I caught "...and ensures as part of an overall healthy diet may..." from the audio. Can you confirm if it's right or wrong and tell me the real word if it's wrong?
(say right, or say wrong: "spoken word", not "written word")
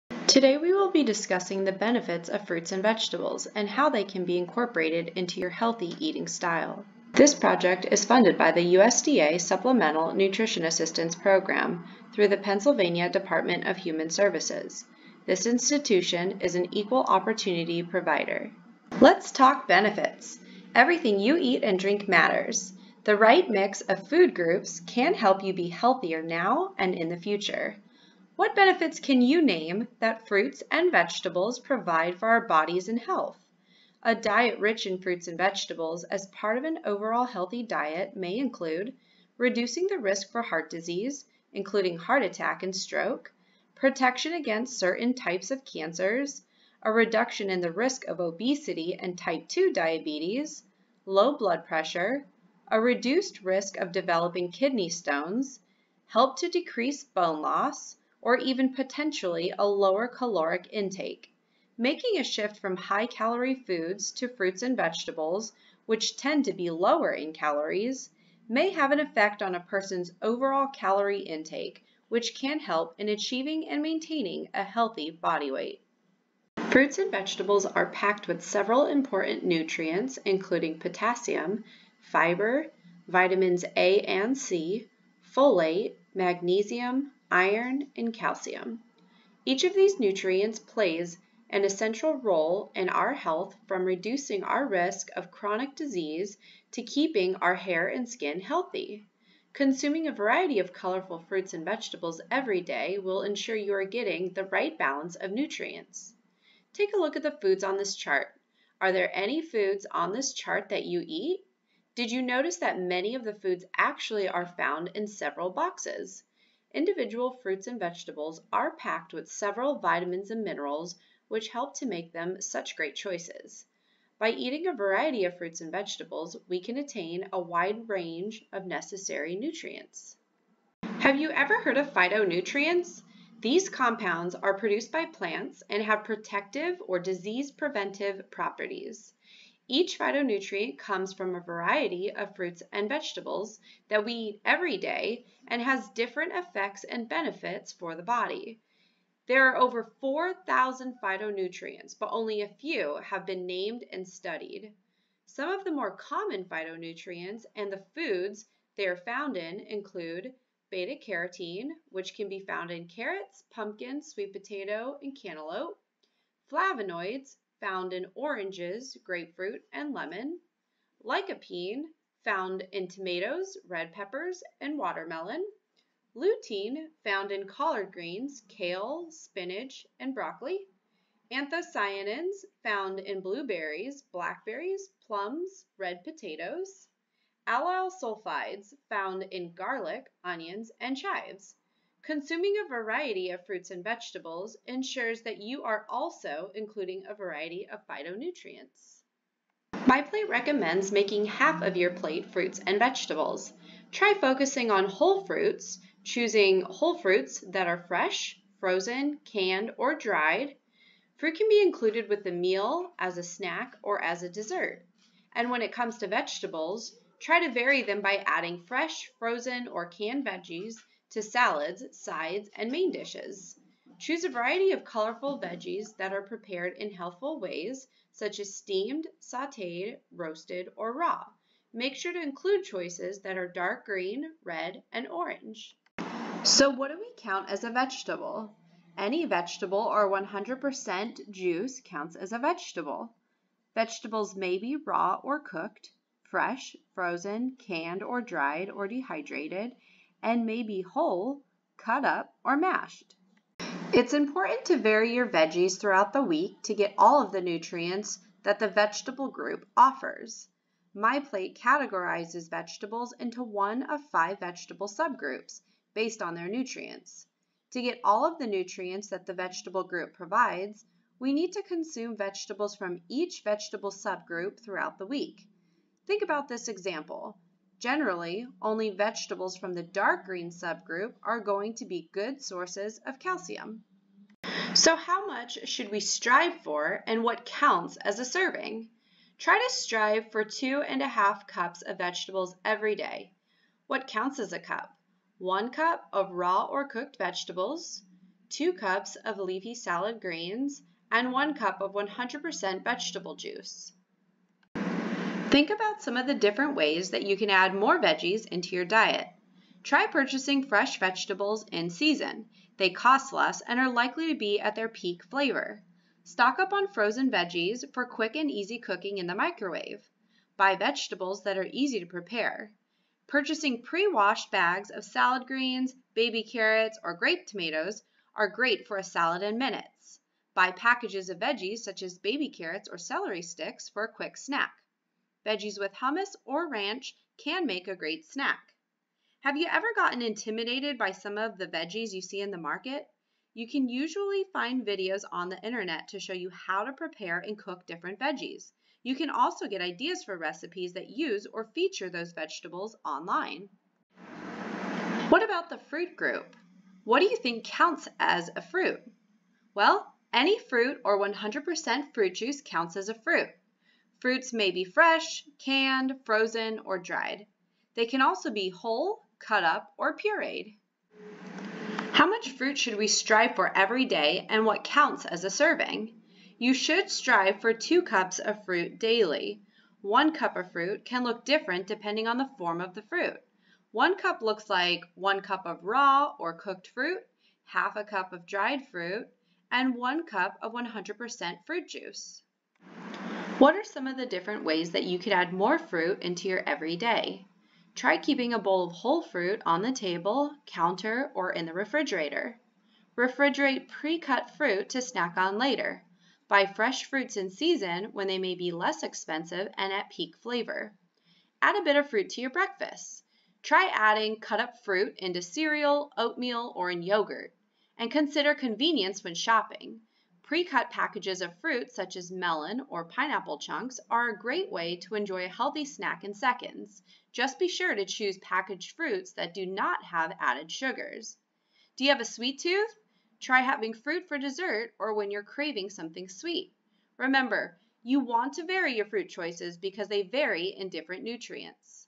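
wrong: "vegetables", not "ensures".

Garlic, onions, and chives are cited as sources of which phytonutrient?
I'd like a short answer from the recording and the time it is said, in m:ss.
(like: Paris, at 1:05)
allyl sulfides, at 3:07.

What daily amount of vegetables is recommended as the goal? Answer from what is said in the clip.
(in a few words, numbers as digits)
2.5 cups.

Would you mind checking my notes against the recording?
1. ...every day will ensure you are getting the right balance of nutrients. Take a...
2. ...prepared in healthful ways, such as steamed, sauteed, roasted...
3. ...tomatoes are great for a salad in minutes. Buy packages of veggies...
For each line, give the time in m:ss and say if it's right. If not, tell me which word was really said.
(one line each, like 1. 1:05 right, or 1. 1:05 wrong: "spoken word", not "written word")
1. 1:42 right
2. 3:46 right
3. 5:27 right.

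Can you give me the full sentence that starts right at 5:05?
Think about some of the different ways that you can add more veggies into your diet.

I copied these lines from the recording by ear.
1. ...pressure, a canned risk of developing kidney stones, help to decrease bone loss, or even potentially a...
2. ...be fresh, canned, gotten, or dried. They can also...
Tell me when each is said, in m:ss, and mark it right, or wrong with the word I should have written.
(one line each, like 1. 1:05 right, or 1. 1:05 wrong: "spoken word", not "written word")
1. 0:51 wrong: "reduced", not "canned"
2. 6:04 wrong: "frozen", not "gotten".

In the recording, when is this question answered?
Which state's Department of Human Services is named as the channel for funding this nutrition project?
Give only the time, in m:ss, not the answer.
0:12.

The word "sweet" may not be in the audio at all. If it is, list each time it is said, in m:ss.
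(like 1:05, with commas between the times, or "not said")
2:44, 7:12, 7:16.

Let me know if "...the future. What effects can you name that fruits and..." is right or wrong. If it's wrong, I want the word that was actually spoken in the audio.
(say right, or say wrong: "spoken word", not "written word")
wrong: "benefits", not "effects".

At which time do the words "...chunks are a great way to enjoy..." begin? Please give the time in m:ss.
7:03.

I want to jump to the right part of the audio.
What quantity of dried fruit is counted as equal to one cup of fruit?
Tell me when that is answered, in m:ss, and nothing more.
6:27.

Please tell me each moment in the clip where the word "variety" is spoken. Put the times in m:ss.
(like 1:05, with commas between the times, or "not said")
1:40, 2:04, 2:21, 3:12, 3:17, 3:44.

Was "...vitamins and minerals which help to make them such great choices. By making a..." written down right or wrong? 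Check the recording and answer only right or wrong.
wrong.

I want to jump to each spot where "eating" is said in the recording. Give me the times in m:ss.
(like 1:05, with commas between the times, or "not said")
0:05, 2:04.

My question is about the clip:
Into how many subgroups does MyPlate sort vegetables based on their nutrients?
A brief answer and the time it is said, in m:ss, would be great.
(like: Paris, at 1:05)
5, at 4:24.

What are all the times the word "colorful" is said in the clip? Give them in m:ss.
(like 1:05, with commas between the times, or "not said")
1:40, 3:44.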